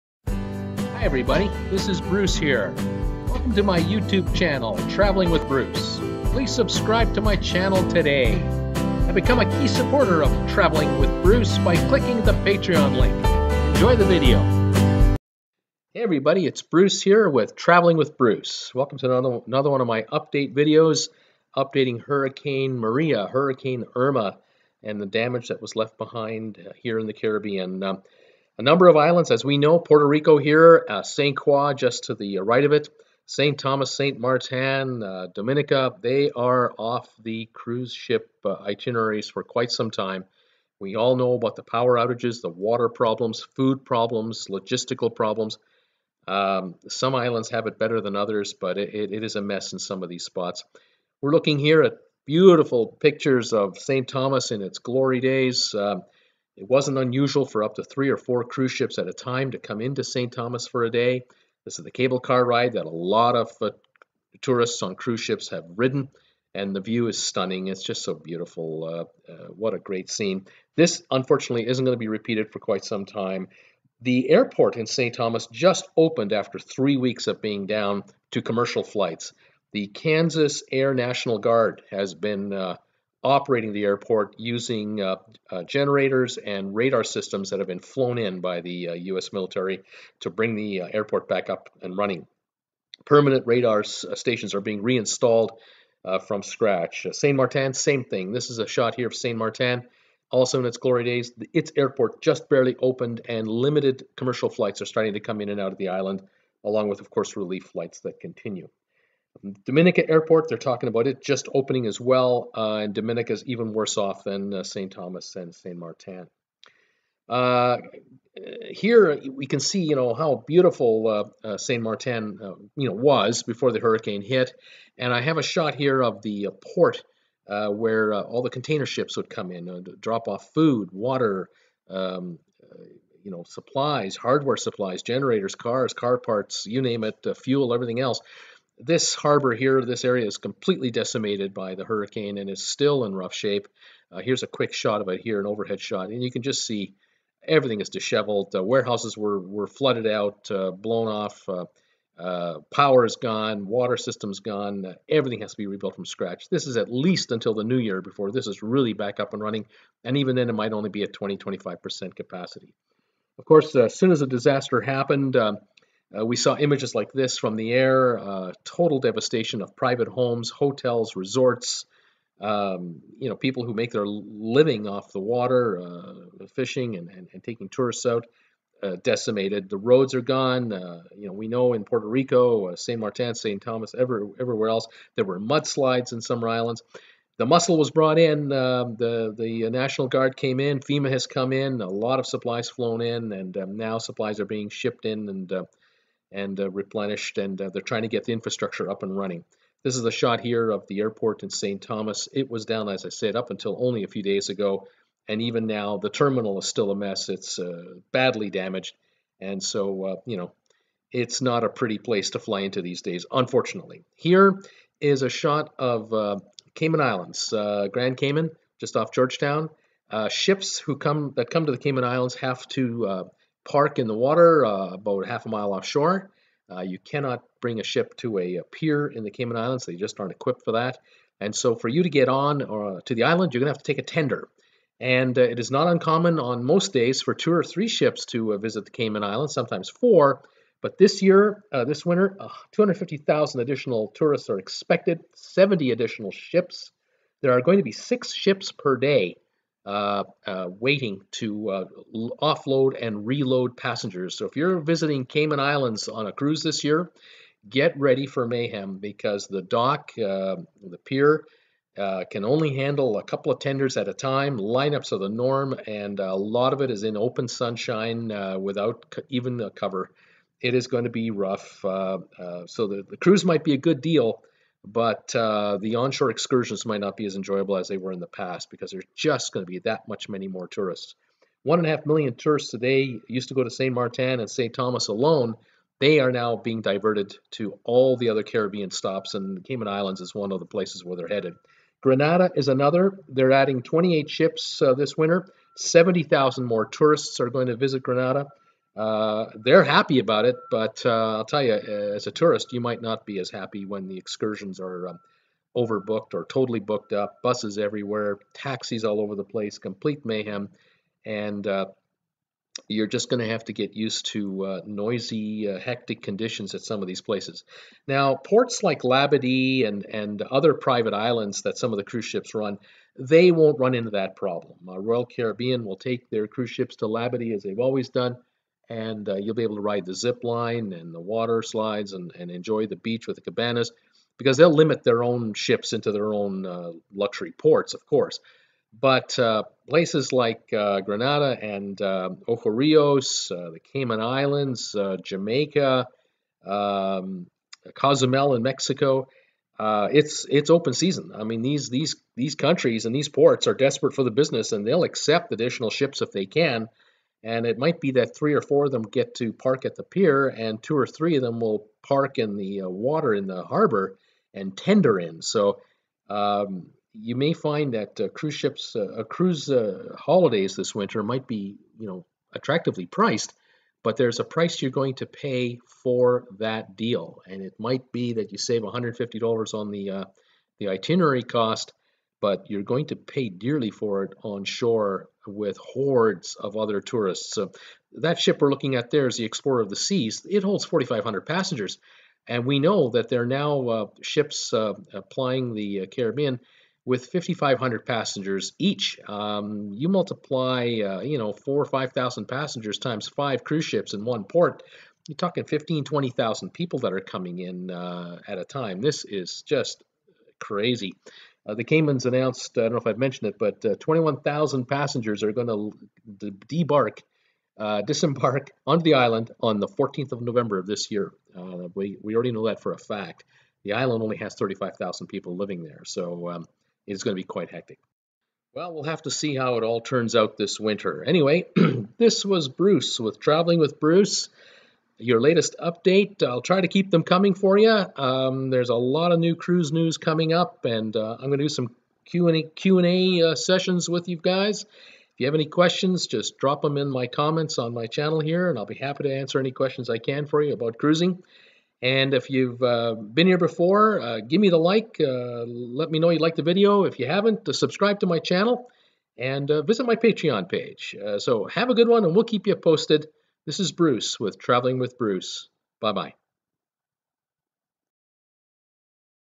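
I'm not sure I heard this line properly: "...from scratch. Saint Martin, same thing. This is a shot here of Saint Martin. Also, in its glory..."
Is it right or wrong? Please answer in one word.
right.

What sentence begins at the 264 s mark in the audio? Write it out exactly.
Lineups are the norm, and a lot of it is in open sunshine without even a cover.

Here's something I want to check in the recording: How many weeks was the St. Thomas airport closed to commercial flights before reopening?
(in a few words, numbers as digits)
3.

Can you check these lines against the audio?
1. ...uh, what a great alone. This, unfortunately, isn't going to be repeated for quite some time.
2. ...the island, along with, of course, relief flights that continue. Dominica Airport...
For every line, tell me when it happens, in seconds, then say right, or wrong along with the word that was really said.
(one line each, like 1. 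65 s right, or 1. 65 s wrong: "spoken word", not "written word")
1. 69 s wrong: "scene", not "alone"
2. 105 s right.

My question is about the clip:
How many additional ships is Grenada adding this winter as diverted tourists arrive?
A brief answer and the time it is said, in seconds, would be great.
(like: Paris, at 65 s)
28, at 293 s.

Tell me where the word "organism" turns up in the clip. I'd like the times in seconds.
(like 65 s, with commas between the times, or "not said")
not said.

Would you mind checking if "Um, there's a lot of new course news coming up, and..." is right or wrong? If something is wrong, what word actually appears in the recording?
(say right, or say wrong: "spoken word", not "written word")
wrong: "cruise", not "course".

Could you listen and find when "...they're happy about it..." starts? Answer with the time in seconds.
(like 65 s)
299 s.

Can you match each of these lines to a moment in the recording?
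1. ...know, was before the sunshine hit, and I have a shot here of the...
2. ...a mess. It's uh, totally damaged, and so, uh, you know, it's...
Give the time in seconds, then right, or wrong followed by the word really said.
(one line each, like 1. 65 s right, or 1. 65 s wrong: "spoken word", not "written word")
1. 122 s wrong: "hurricane", not "sunshine"
2. 206 s wrong: "badly", not "totally".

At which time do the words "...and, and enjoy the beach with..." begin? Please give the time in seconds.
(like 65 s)
332 s.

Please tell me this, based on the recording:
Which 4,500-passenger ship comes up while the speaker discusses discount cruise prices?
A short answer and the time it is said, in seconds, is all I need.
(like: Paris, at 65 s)
Explorer of the Seas, at 389 s.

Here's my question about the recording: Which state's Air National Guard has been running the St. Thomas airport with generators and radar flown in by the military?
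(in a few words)
Kansas.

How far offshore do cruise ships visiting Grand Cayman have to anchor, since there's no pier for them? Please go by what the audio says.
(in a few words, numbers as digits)
half a mile.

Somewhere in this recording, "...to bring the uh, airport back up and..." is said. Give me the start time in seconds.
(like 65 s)
90 s.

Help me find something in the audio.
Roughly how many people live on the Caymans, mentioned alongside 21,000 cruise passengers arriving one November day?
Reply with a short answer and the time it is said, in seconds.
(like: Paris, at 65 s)
35,000, at 424 s.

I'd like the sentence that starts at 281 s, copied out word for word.
One and a half million tourists today used to go to St.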